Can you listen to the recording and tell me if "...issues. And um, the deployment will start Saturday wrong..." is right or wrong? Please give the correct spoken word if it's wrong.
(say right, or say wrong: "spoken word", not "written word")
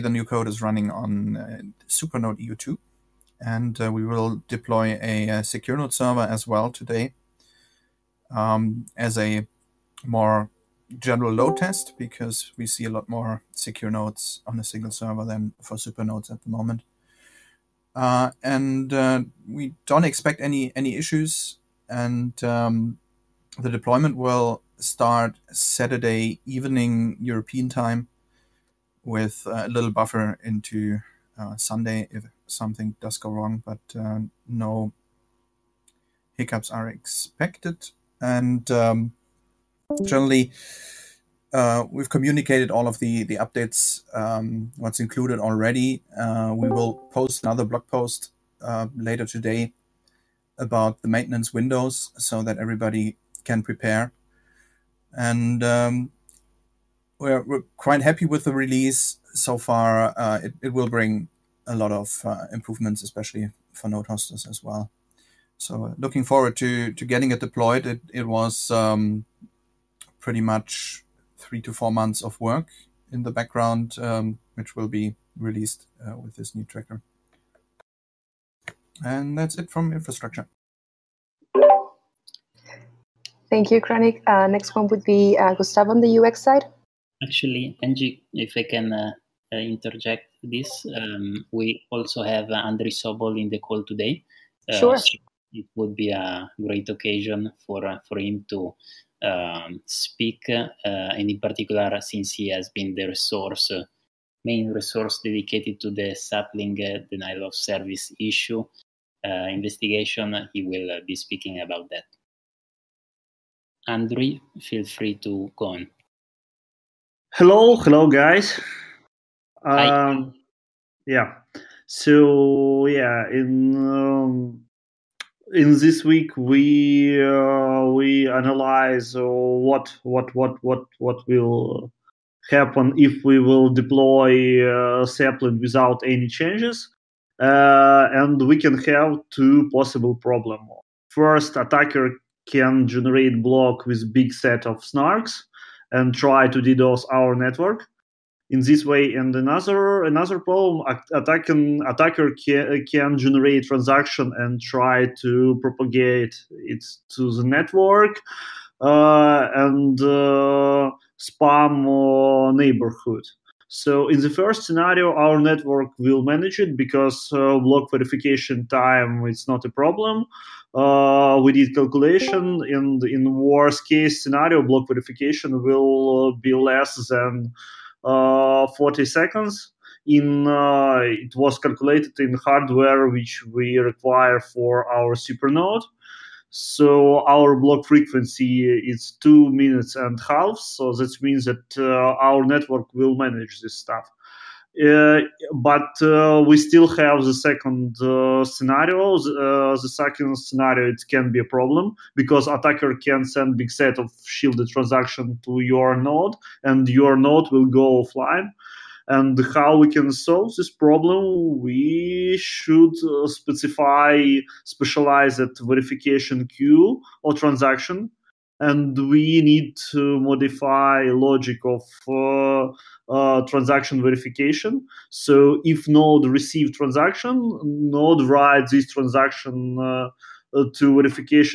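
wrong: "evening", not "wrong".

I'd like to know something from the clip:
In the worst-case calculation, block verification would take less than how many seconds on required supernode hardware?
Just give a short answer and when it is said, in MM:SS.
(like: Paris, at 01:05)
40 seconds, at 02:58.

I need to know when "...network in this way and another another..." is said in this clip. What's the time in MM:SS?
02:27.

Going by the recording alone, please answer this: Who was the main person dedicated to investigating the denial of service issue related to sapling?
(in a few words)
Andrei Sobol.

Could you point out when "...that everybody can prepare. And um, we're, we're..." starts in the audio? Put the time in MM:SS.
00:52.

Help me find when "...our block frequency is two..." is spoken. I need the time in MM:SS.
03:07.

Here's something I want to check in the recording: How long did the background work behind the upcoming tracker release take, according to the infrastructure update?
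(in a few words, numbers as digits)
3 to 4 months.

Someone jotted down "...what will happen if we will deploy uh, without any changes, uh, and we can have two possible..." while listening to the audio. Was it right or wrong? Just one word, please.
right.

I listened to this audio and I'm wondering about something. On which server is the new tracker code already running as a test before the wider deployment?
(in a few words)
Supernode EU2.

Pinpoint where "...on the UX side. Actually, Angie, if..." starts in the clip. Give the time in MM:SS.
01:25.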